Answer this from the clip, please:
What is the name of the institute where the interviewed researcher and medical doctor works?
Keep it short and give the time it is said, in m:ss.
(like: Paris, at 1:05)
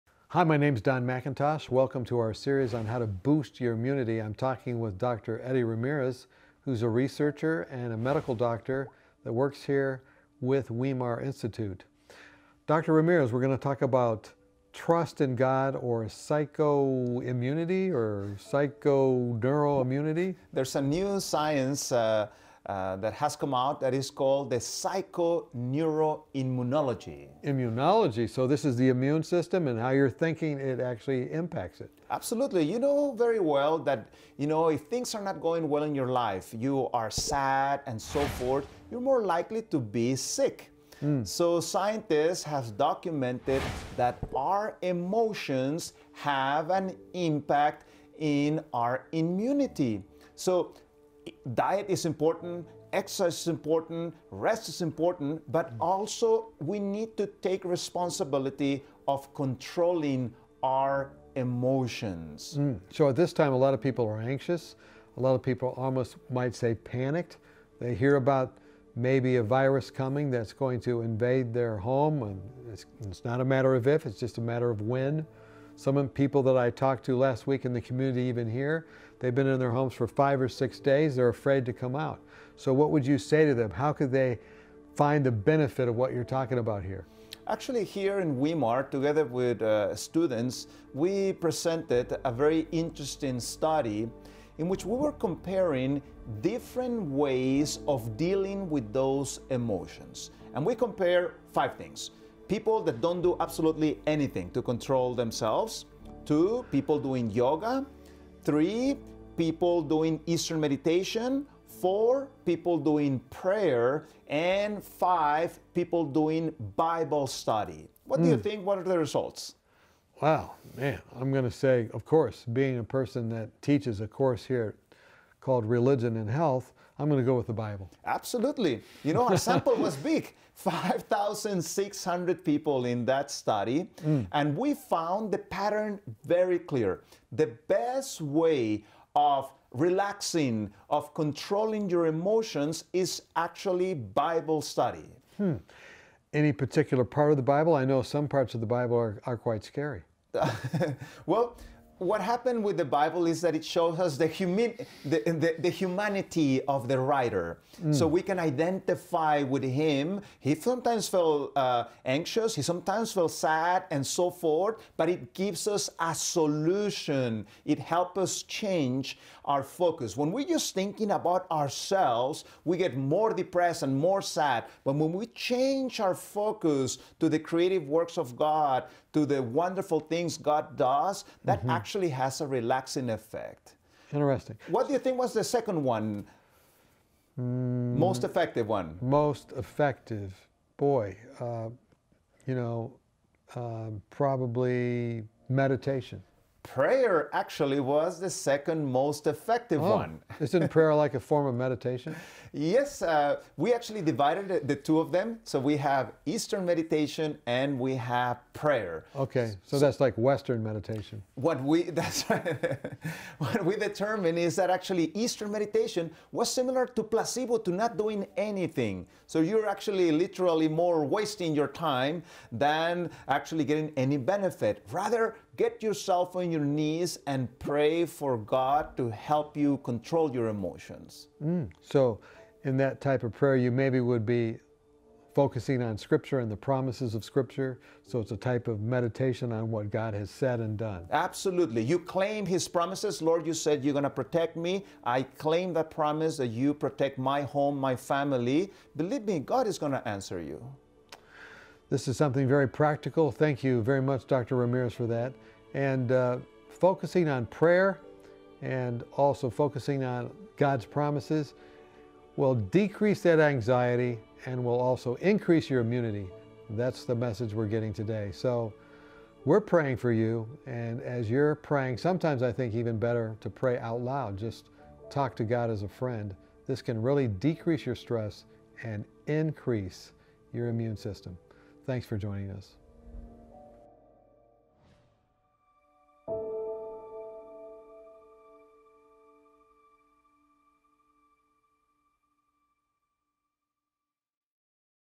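Weimar Institute, at 0:10.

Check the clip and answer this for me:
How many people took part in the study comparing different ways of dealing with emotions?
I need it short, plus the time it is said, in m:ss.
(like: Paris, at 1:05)
5,600, at 2:10.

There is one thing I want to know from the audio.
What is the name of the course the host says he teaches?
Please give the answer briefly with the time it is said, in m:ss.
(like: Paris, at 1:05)
Religion and Health, at 2:05.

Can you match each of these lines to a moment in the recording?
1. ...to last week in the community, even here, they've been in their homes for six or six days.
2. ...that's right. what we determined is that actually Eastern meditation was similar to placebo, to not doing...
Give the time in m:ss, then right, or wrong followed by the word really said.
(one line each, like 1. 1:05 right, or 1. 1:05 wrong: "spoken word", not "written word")
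1. 1:17 wrong: "five", not "six"
2. 3:31 right.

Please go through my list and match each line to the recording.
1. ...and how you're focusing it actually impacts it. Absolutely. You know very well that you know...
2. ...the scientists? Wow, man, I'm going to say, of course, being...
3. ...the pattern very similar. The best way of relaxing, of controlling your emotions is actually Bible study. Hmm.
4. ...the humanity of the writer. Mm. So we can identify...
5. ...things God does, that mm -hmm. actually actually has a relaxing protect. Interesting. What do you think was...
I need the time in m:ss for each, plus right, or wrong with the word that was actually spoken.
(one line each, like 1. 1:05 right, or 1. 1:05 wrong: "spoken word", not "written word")
1. 0:29 wrong: "thinking", not "focusing"
2. 1:58 wrong: "results", not "scientists"
3. 2:15 wrong: "clear", not "similar"
4. 2:35 right
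5. 2:59 wrong: "effect", not "protect".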